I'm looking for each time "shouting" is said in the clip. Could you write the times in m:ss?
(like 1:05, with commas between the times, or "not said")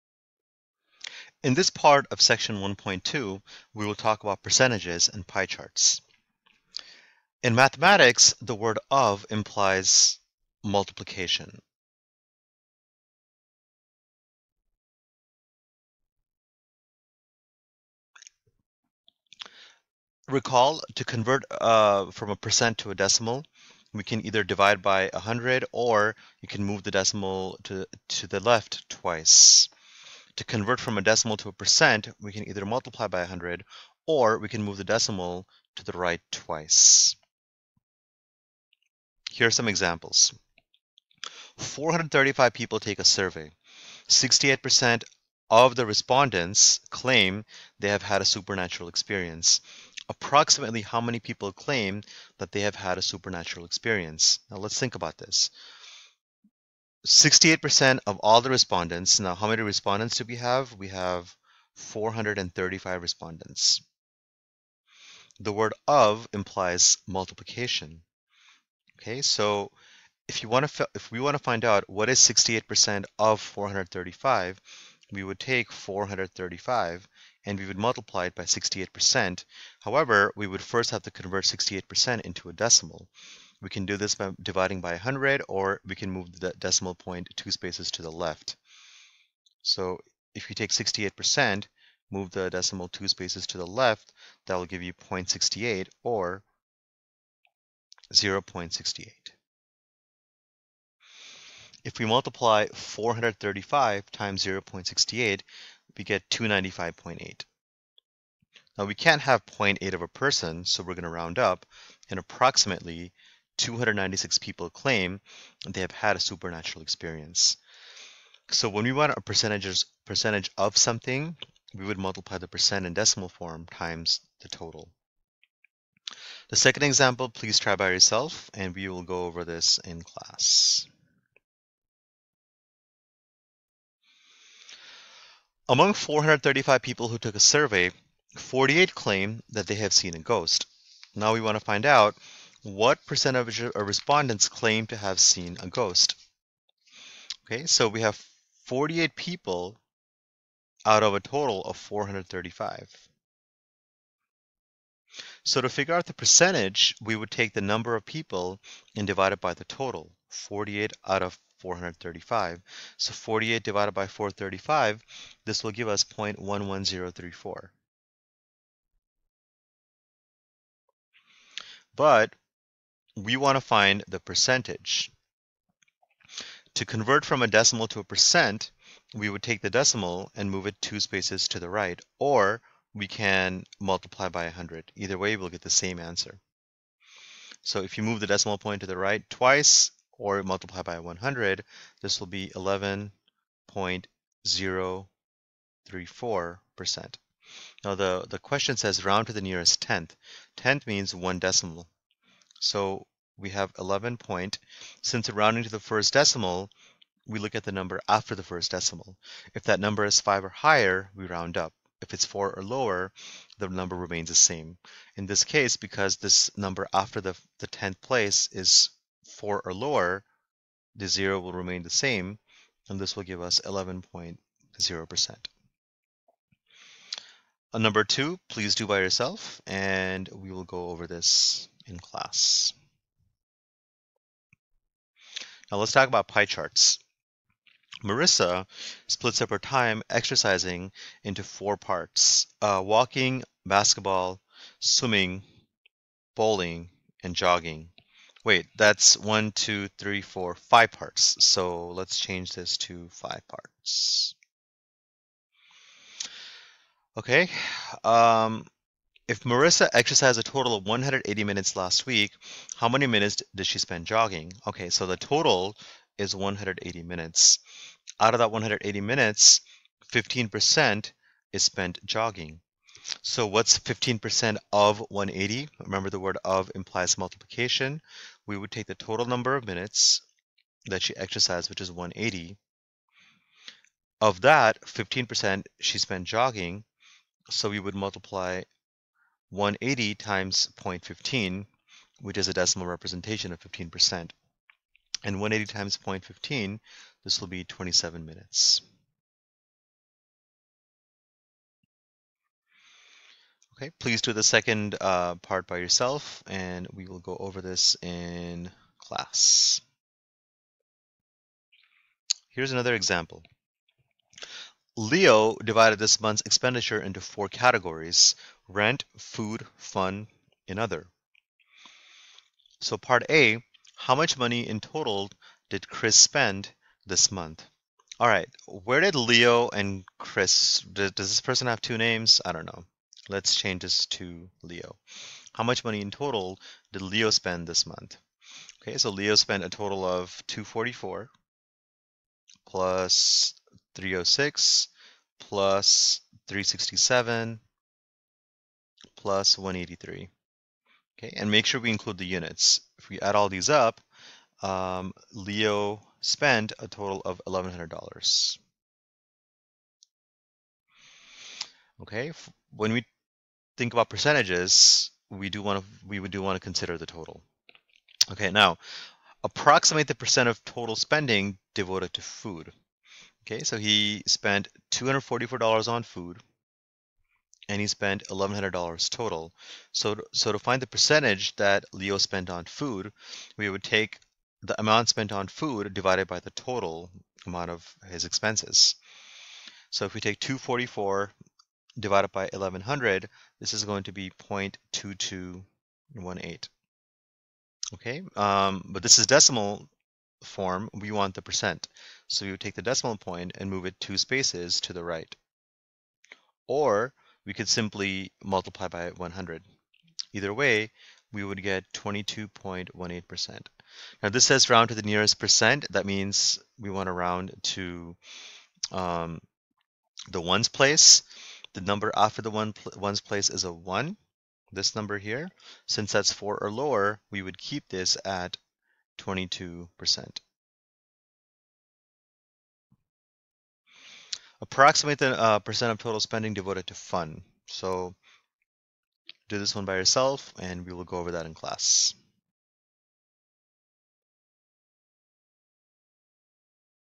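not said.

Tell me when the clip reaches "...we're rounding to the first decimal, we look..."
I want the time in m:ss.
3:25.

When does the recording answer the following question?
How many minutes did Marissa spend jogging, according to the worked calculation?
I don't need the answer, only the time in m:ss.
4:57.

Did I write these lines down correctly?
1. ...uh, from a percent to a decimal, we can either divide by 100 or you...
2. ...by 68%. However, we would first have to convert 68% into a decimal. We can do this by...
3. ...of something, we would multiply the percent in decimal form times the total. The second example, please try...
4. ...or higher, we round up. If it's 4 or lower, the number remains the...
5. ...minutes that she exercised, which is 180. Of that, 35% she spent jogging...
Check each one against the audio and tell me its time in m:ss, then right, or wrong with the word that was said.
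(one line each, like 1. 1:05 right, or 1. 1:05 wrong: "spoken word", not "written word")
1. 0:21 right
2. 1:18 right
3. 2:00 right
4. 3:30 right
5. 4:39 wrong: "15", not "35".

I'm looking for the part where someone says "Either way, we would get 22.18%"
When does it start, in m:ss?
6:50.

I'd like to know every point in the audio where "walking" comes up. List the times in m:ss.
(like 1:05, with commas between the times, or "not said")
4:02.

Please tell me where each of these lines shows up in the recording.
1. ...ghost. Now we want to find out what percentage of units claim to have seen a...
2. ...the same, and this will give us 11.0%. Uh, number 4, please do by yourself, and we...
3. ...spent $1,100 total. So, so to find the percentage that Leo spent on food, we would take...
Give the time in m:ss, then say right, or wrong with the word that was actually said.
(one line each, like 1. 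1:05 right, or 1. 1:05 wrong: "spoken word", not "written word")
1. 2:20 wrong: "respondents", not "units"
2. 3:41 wrong: "2", not "4"
3. 6:17 right.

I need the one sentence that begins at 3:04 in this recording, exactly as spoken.
Either way, we'll get the same answer.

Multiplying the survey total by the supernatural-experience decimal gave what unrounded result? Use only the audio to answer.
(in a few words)
295.8.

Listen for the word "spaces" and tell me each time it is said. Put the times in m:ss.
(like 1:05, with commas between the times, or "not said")
1:27, 1:33, 3:01, 6:44.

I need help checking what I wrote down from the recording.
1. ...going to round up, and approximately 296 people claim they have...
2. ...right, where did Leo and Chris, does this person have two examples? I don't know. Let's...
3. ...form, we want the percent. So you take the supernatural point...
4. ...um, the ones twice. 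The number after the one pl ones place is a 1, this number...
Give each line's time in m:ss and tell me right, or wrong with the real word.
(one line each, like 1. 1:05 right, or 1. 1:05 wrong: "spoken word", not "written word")
1. 1:50 right
2. 5:28 wrong: "names", not "examples"
3. 6:40 wrong: "decimal", not "supernatural"
4. 6:58 wrong: "place", not "twice".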